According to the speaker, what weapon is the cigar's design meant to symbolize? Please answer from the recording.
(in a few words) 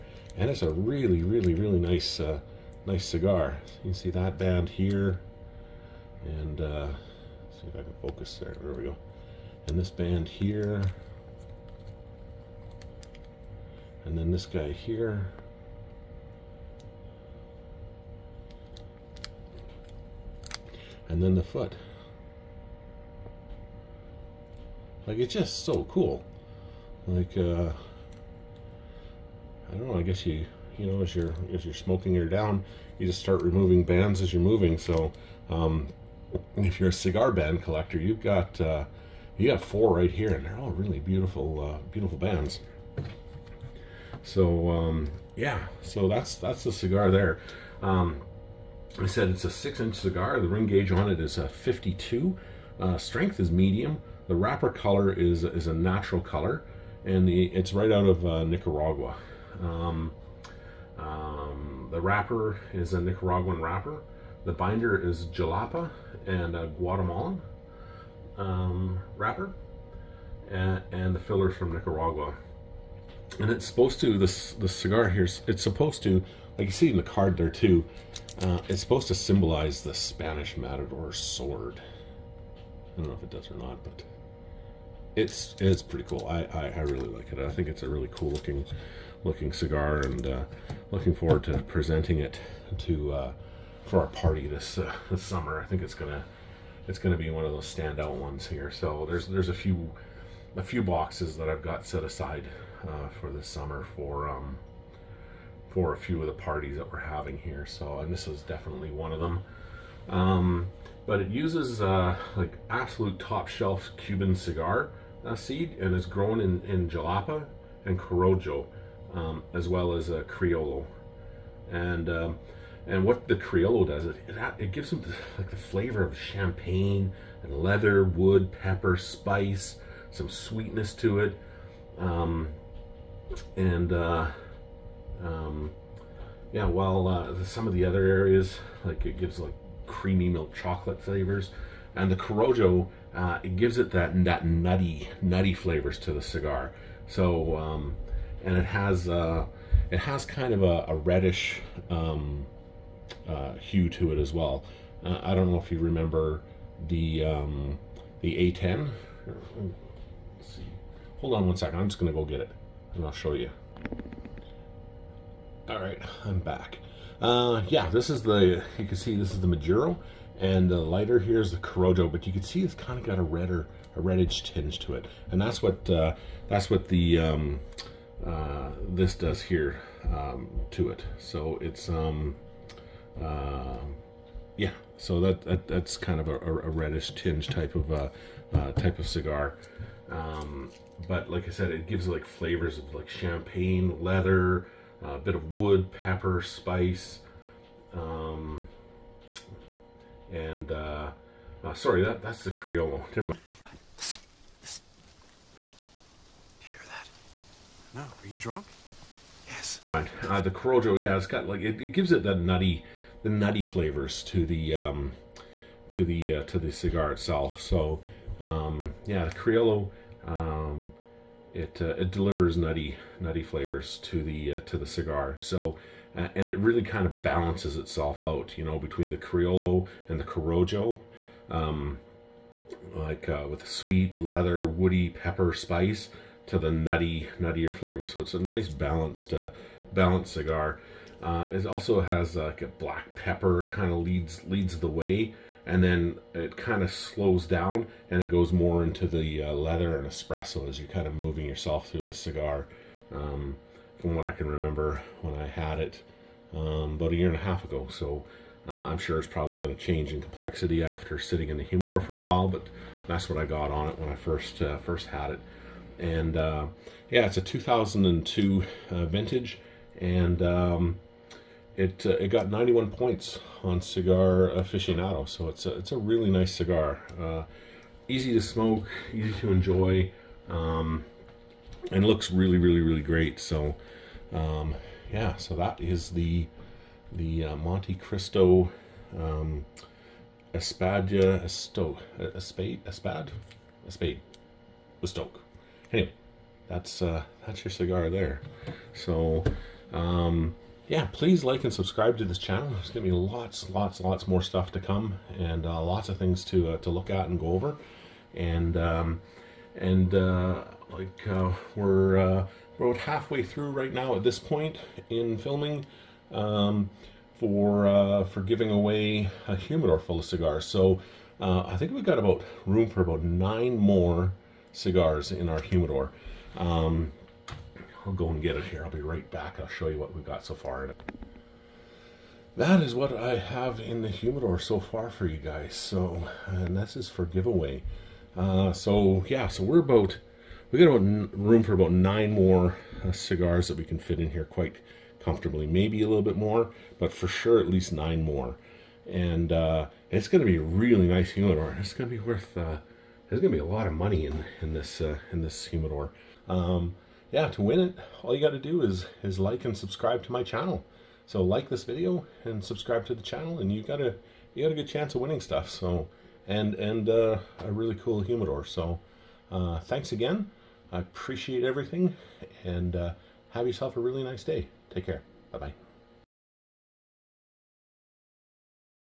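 Spanish matador sword.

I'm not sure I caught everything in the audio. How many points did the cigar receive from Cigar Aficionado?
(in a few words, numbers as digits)
91.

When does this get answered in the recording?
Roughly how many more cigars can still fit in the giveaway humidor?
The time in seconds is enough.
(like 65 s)
323 s.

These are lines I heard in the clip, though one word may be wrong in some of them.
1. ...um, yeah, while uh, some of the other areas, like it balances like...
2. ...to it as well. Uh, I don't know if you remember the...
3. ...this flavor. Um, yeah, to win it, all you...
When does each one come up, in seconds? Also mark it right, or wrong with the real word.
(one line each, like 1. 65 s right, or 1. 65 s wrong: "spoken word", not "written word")
1. 135 s wrong: "gives", not "balances"
2. 153 s right
3. 355 s wrong: "humidor", not "flavor".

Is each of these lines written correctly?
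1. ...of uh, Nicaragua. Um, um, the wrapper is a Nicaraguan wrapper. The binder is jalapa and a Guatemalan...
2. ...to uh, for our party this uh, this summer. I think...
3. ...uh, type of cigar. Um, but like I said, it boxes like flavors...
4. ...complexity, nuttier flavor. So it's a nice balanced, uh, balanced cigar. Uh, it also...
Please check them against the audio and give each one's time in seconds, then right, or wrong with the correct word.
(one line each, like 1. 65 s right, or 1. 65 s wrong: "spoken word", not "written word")
1. 58 s right
2. 92 s right
3. 188 s wrong: "gives", not "boxes"
4. 236 s wrong: "nutty", not "complexity".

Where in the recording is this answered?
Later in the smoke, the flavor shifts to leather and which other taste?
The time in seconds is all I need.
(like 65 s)
250 s.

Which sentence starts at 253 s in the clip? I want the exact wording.
Um, from what I can remember when I had it um, about a year and a half ago.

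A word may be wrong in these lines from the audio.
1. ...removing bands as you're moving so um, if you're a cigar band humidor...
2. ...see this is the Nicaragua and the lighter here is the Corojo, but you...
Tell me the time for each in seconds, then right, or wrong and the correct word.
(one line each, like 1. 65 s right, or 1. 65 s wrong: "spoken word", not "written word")
1. 33 s wrong: "collector", not "humidor"
2. 168 s wrong: "Maduro", not "Nicaragua".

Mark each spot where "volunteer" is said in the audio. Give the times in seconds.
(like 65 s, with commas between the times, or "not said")
not said.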